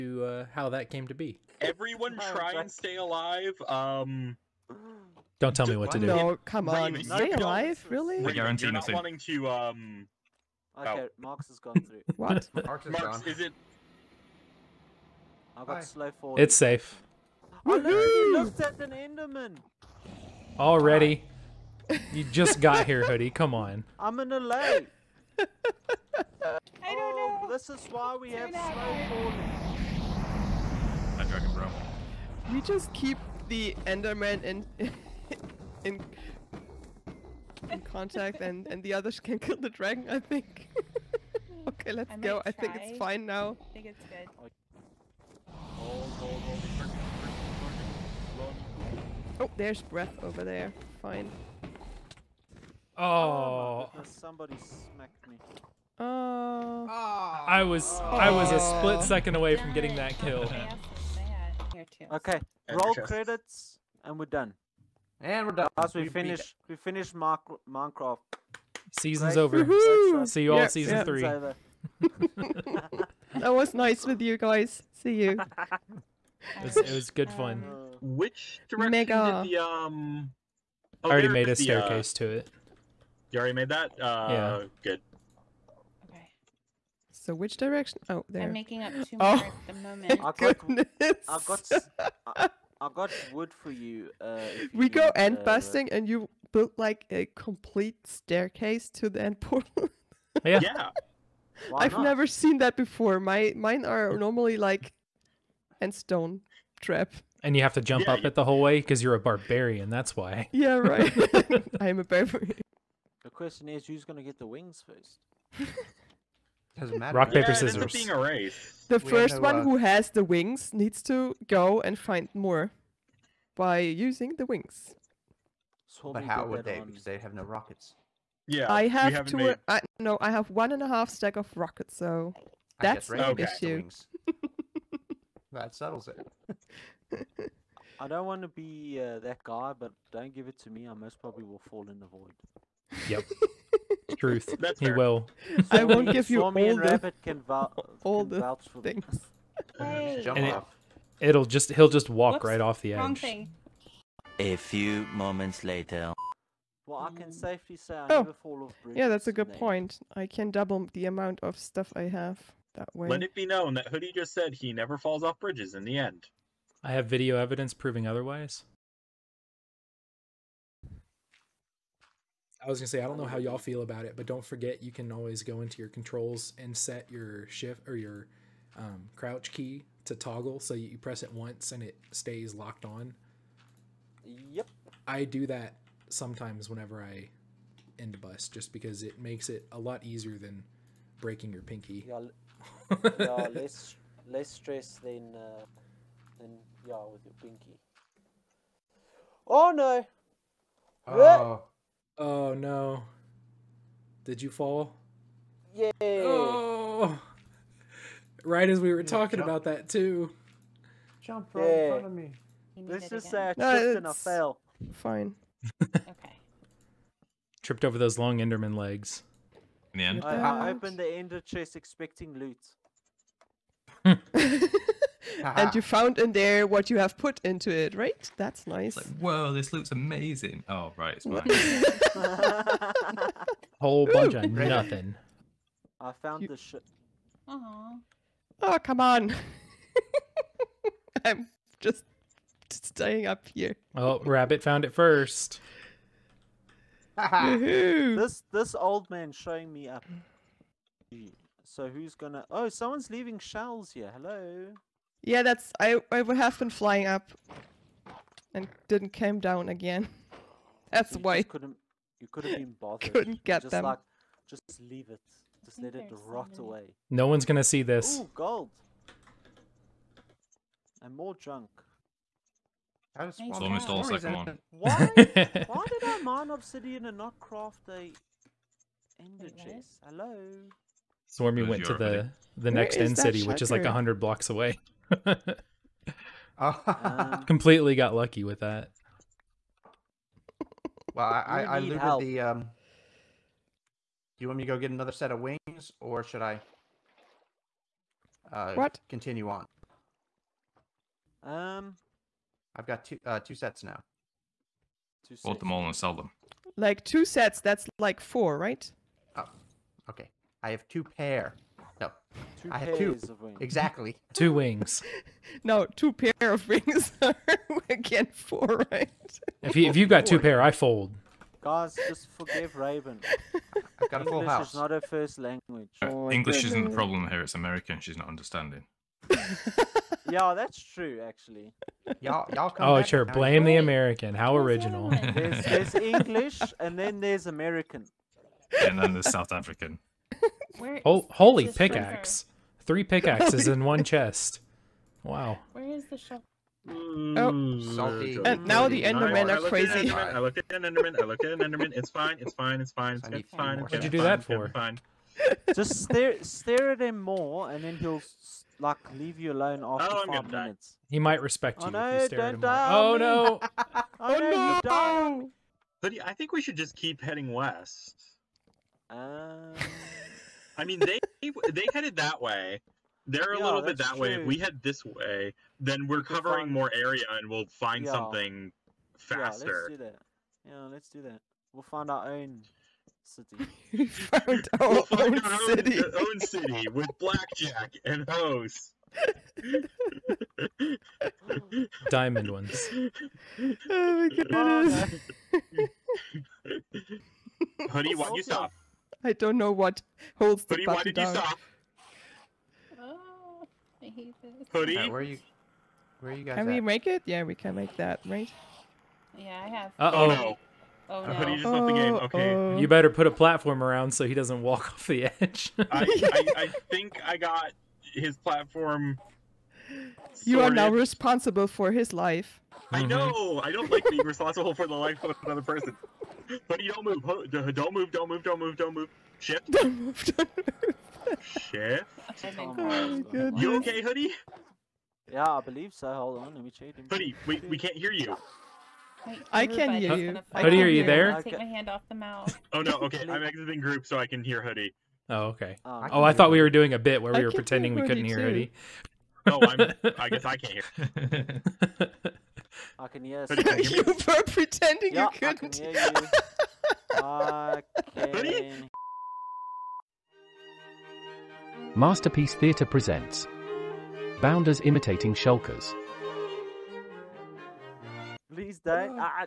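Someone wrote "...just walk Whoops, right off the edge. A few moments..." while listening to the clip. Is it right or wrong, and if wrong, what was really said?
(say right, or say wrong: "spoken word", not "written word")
right.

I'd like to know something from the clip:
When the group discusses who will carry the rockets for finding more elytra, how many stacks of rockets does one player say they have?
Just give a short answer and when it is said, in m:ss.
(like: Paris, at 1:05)
1.5 stacks, at 2:10.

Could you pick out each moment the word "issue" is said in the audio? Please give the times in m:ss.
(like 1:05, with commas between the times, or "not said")
2:13.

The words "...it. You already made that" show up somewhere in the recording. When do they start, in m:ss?
1:22.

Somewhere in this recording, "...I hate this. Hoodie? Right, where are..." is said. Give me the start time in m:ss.
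6:44.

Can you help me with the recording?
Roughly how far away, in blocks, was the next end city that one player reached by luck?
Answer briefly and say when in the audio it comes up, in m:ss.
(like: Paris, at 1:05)
100 blocks, at 4:43.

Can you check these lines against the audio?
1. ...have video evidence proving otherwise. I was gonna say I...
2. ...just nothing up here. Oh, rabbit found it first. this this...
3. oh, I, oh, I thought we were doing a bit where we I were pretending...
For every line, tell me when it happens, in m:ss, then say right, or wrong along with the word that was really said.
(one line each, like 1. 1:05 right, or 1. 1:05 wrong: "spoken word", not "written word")
1. 2:46 right
2. 4:01 wrong: "staying", not "nothing"
3. 7:25 right.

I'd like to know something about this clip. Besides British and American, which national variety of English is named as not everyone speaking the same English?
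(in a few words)
South African.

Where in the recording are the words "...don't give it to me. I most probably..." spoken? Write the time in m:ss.
2:20.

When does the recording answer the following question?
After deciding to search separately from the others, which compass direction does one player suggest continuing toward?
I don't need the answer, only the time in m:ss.
6:07.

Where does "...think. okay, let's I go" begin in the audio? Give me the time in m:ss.
0:40.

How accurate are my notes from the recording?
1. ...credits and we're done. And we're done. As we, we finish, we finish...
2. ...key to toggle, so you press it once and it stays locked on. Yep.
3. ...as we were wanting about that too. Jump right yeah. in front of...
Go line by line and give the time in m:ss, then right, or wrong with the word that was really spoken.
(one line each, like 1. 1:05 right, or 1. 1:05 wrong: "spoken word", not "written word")
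1. 1:02 right
2. 2:59 right
3. 3:28 wrong: "talking", not "wanting".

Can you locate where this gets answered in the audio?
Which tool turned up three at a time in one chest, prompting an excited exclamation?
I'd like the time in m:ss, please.
5:42.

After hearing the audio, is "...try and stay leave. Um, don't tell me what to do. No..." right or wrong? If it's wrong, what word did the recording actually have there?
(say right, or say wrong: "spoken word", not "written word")
wrong: "alive", not "leave".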